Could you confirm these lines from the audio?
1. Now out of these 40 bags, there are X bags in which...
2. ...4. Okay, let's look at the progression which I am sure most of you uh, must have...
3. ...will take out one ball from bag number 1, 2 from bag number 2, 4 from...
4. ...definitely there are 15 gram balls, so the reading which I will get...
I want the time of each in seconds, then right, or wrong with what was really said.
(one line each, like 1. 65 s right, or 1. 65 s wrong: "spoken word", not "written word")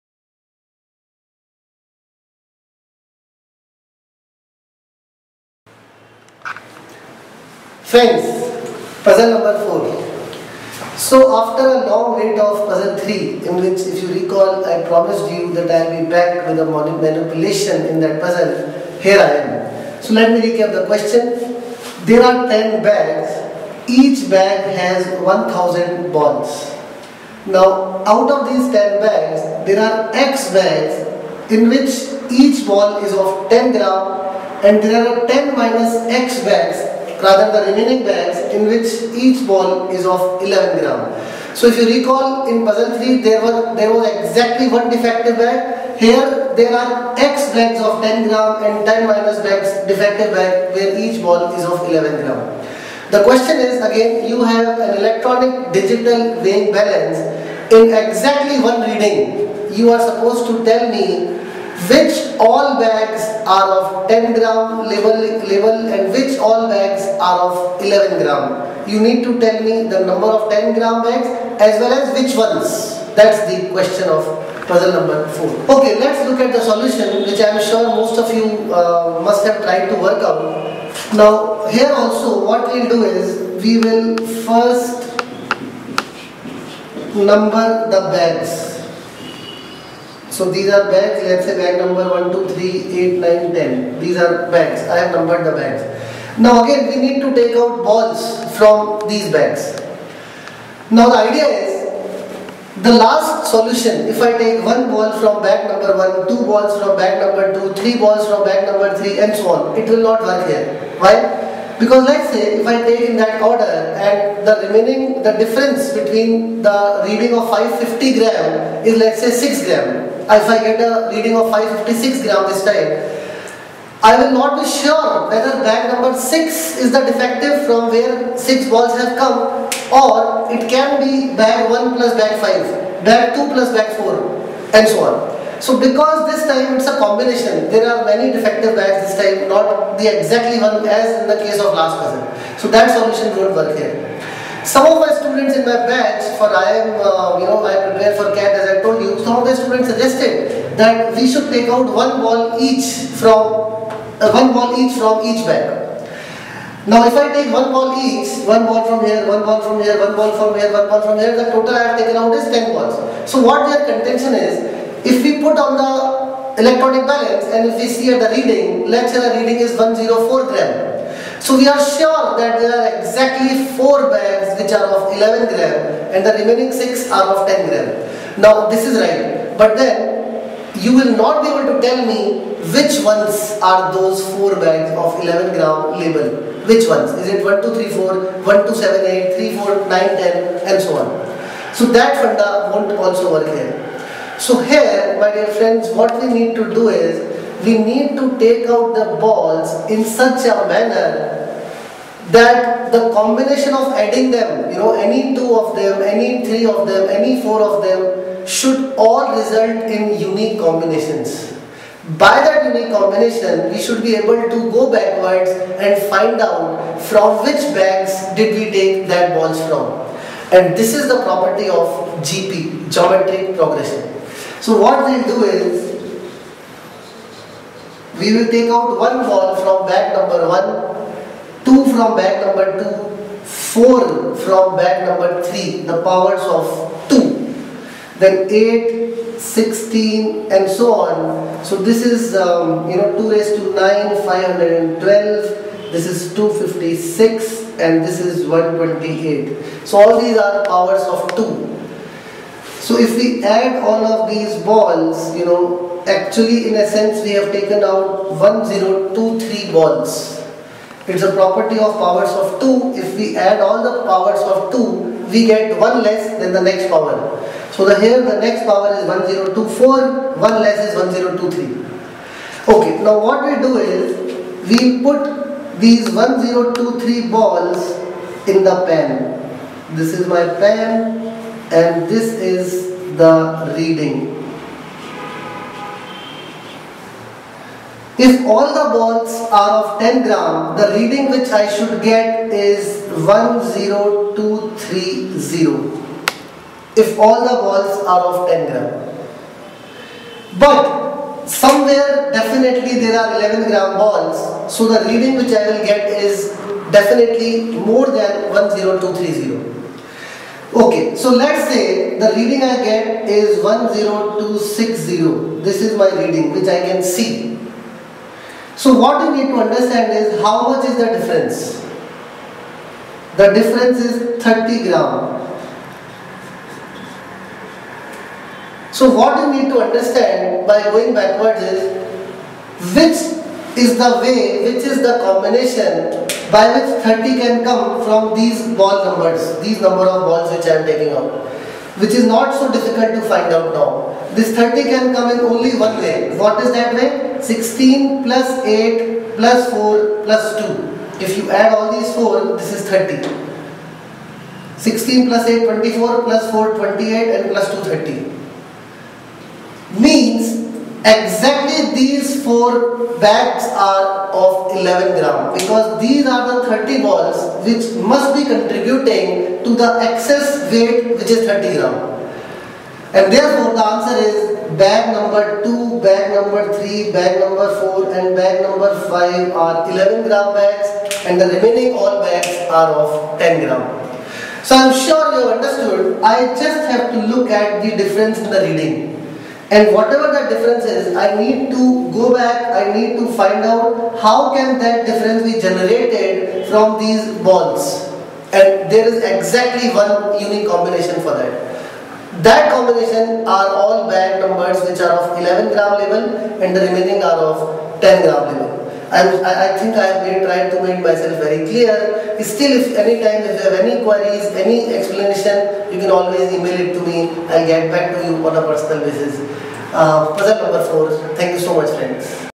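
1. 27 s wrong: "10", not "40"
2. 75 s wrong: "solution", not "progression"
3. 228 s right
4. 302 s wrong: "11", not "15".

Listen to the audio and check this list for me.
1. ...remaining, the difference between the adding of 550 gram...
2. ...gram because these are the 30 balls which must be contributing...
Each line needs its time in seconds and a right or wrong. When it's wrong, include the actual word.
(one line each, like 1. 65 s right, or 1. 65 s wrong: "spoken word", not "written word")
1. 114 s wrong: "reading", not "adding"
2. 365 s right.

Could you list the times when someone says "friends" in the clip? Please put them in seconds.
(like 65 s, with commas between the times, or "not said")
7 s, 195 s, 421 s.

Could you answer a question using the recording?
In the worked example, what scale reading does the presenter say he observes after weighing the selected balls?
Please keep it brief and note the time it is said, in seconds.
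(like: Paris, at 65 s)
10260, at 313 s.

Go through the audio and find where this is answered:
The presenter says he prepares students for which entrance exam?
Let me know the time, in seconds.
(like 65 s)
148 s.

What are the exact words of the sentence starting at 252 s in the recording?
So if we add all of these balls, you know, actually in a sense we have taken out 1023 balls.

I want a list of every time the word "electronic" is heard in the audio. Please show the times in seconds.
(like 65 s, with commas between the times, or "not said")
55 s, 166 s.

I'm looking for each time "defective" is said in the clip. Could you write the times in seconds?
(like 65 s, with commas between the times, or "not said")
44 s, 49 s, 127 s, 138 s.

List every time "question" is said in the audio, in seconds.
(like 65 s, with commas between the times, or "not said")
20 s, 53 s, 73 s.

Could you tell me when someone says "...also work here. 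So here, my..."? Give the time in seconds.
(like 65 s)
192 s.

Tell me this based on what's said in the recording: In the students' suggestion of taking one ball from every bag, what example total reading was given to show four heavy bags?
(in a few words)
104 gram.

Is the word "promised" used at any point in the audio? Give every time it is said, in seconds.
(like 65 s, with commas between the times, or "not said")
14 s.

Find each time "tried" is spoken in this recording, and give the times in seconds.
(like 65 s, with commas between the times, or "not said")
79 s, 410 s.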